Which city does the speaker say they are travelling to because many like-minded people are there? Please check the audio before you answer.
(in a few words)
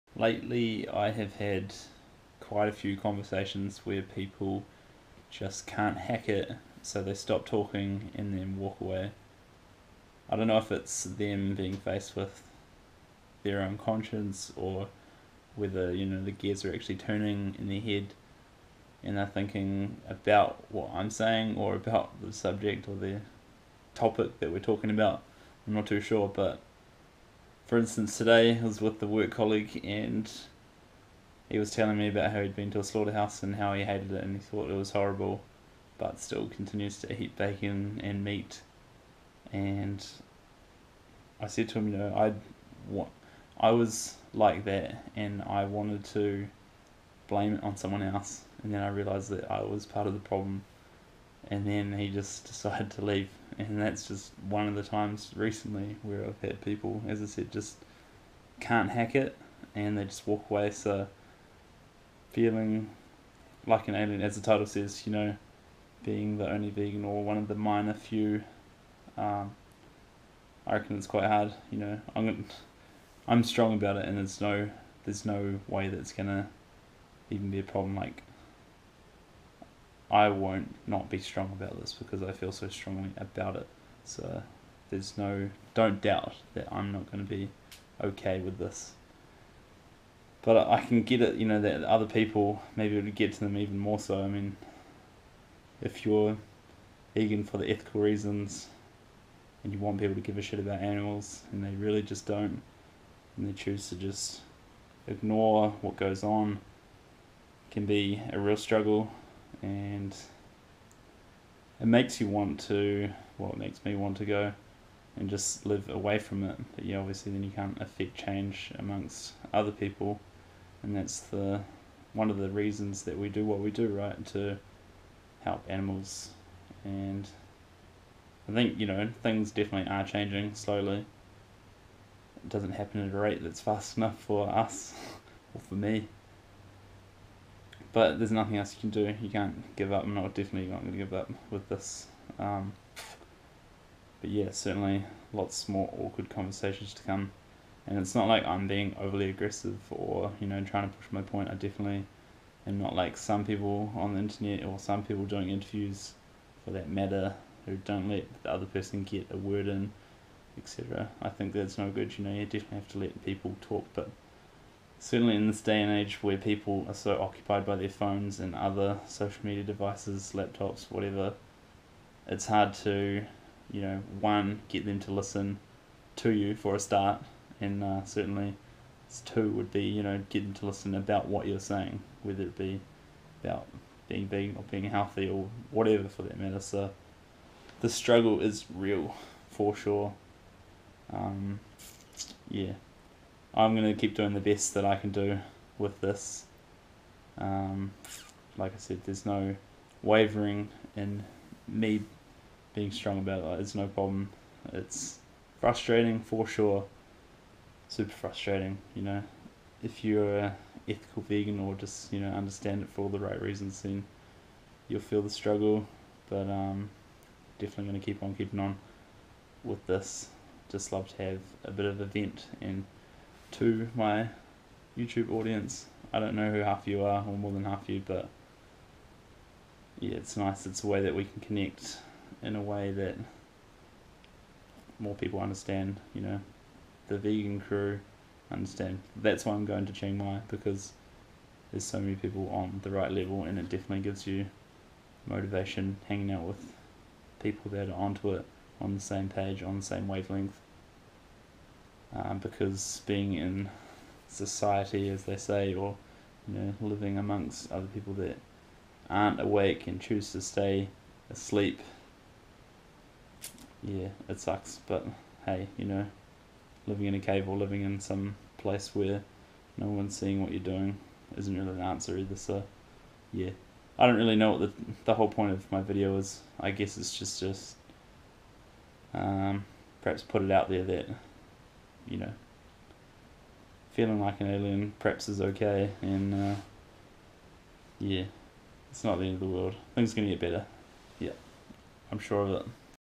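Chiang Mai.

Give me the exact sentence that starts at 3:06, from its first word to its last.
So the struggle is real for sure.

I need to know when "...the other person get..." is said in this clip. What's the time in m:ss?
2:38.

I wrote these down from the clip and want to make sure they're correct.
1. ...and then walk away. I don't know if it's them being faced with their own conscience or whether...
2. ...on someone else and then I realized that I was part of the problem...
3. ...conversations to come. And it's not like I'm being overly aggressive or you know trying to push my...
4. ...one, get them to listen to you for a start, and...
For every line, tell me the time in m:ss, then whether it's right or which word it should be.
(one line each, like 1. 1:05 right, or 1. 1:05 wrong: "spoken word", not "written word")
1. 0:08 right
2. 0:47 right
3. 2:26 right
4. 2:54 right.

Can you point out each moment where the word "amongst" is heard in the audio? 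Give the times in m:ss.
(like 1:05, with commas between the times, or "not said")
1:58, 4:17.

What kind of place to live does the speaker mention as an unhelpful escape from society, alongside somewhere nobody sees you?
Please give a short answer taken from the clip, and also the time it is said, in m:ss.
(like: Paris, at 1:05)
a cave, at 4:27.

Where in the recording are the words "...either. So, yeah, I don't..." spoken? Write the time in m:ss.
4:32.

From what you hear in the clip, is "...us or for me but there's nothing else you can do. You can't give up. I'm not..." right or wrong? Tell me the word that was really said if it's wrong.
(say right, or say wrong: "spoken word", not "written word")
right.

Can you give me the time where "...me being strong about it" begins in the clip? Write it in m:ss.
3:21.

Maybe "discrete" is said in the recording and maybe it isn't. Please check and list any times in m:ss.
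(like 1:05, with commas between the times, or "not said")
not said.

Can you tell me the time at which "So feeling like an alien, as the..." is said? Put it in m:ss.
1:00.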